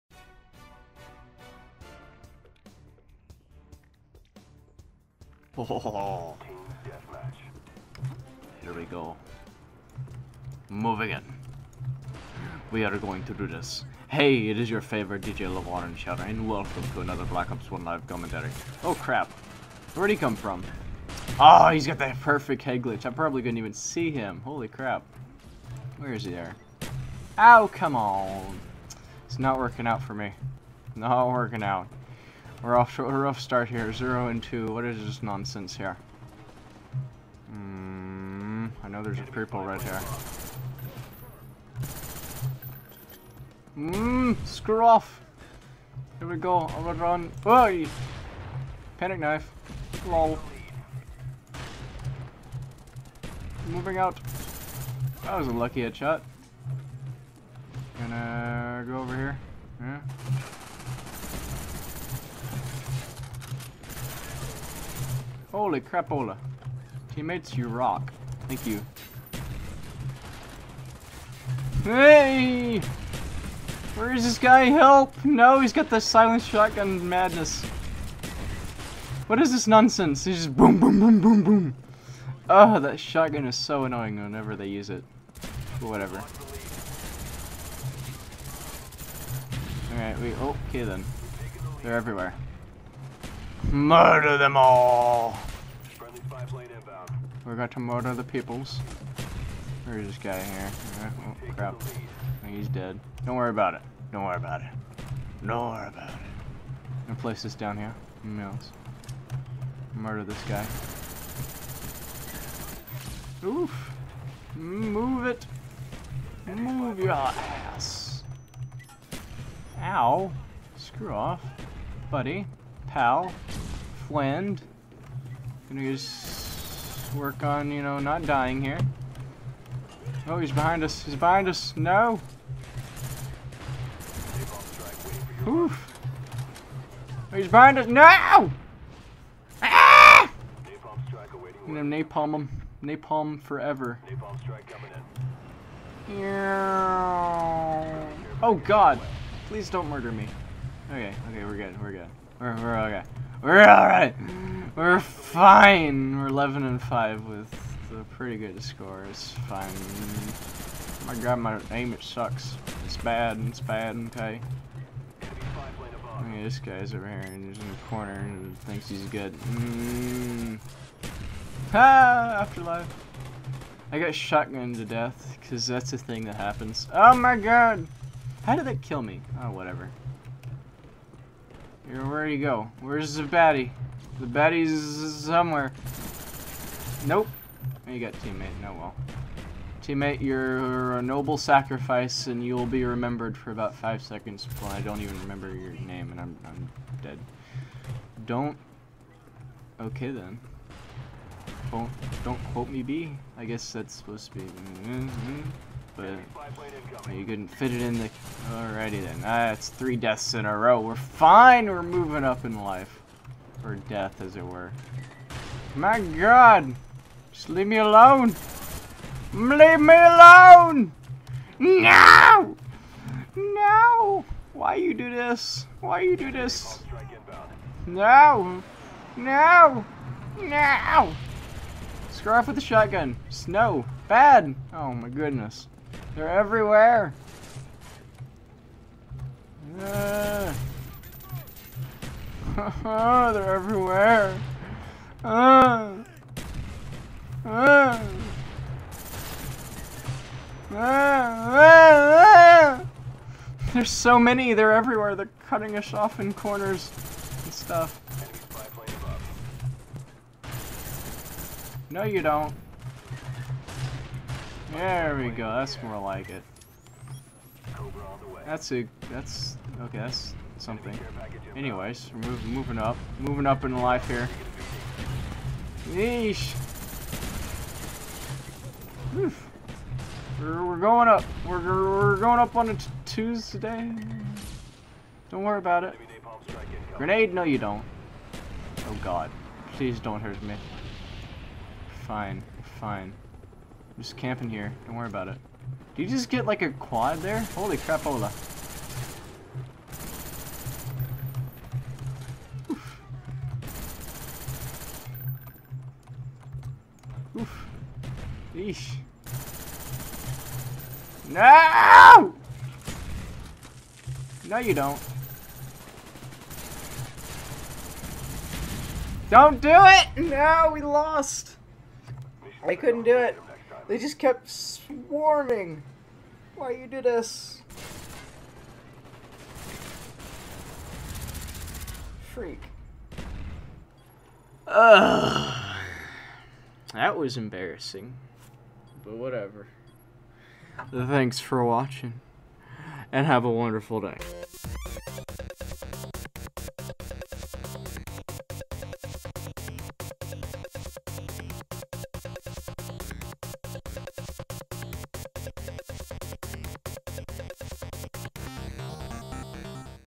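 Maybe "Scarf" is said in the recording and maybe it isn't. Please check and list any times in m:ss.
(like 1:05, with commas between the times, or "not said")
3:52.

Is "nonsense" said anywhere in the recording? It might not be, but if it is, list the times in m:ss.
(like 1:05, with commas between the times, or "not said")
0:35, 1:19.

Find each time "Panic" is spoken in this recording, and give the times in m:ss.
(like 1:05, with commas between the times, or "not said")
0:48.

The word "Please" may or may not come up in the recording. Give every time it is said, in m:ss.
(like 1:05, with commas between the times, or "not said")
2:29, 4:49.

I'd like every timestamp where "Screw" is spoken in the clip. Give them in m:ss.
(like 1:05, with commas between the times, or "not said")
0:44, 2:00.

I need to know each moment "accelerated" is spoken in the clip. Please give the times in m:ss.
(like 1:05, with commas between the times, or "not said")
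not said.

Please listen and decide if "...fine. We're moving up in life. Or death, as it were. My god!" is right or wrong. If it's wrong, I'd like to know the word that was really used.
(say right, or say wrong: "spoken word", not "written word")
right.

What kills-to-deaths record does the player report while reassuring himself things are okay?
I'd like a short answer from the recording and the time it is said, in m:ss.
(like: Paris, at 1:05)
11 and 5, at 2:36.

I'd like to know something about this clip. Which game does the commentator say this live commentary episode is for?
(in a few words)
Black Ops 1.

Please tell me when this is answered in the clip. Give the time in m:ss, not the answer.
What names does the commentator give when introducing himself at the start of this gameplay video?
0:15.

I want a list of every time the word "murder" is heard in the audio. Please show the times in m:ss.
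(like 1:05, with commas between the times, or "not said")
1:33, 1:37, 1:49, 2:29.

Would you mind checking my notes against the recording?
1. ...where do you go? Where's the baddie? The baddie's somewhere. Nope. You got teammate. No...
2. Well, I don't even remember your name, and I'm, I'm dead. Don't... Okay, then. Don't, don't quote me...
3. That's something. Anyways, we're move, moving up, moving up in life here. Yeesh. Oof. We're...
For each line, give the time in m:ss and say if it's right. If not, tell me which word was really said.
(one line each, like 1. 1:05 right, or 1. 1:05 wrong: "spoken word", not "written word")
1. 3:01 right
2. 3:14 right
3. 4:29 right.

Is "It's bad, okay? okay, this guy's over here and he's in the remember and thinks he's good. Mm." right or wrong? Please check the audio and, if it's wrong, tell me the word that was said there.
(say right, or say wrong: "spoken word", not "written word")
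wrong: "corner", not "remember".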